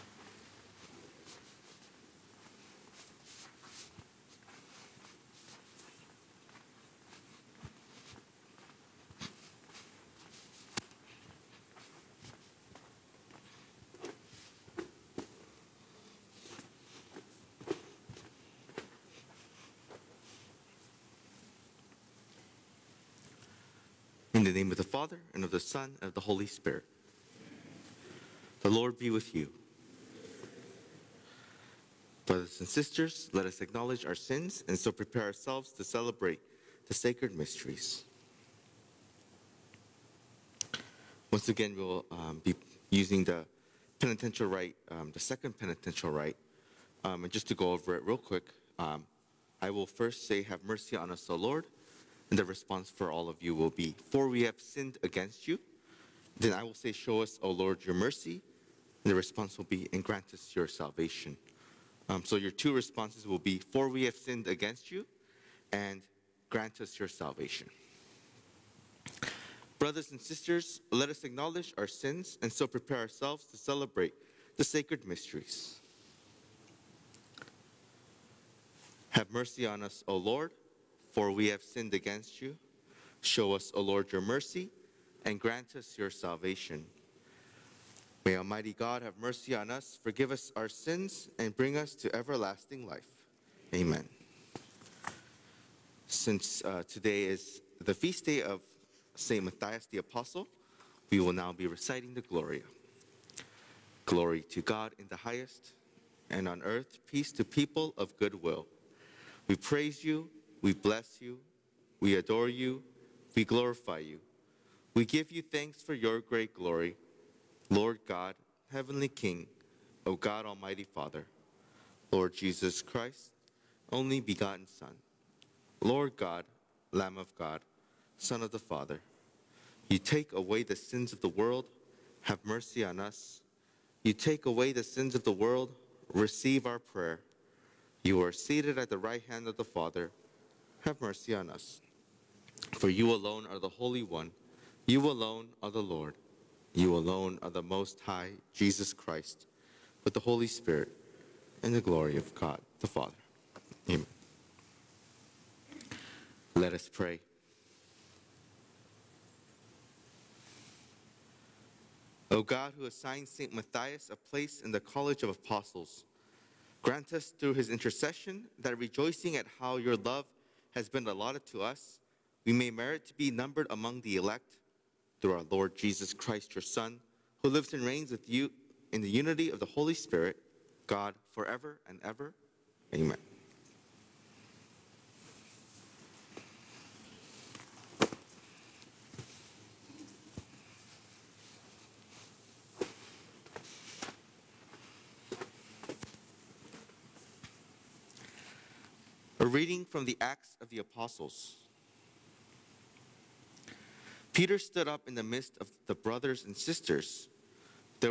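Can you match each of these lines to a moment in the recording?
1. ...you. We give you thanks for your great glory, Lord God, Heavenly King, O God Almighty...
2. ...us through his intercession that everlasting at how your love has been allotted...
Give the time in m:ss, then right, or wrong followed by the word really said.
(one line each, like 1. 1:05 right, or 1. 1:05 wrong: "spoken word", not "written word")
1. 1:53 right
2. 2:47 wrong: "rejoicing", not "everlasting".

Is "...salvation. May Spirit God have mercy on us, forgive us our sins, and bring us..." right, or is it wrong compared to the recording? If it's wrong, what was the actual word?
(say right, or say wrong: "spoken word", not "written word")
wrong: "Almighty", not "Spirit".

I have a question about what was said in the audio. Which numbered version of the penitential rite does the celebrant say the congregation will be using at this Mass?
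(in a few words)
Second.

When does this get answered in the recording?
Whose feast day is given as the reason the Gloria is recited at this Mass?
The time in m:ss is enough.
1:39.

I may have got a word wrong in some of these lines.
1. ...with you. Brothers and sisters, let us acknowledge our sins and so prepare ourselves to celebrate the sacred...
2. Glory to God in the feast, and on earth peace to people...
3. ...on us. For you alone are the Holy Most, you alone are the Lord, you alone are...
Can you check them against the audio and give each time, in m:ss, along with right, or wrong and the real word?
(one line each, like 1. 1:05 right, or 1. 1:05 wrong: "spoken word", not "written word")
1. 0:29 right
2. 1:44 wrong: "highest", not "feast"
3. 2:21 wrong: "One", not "Most".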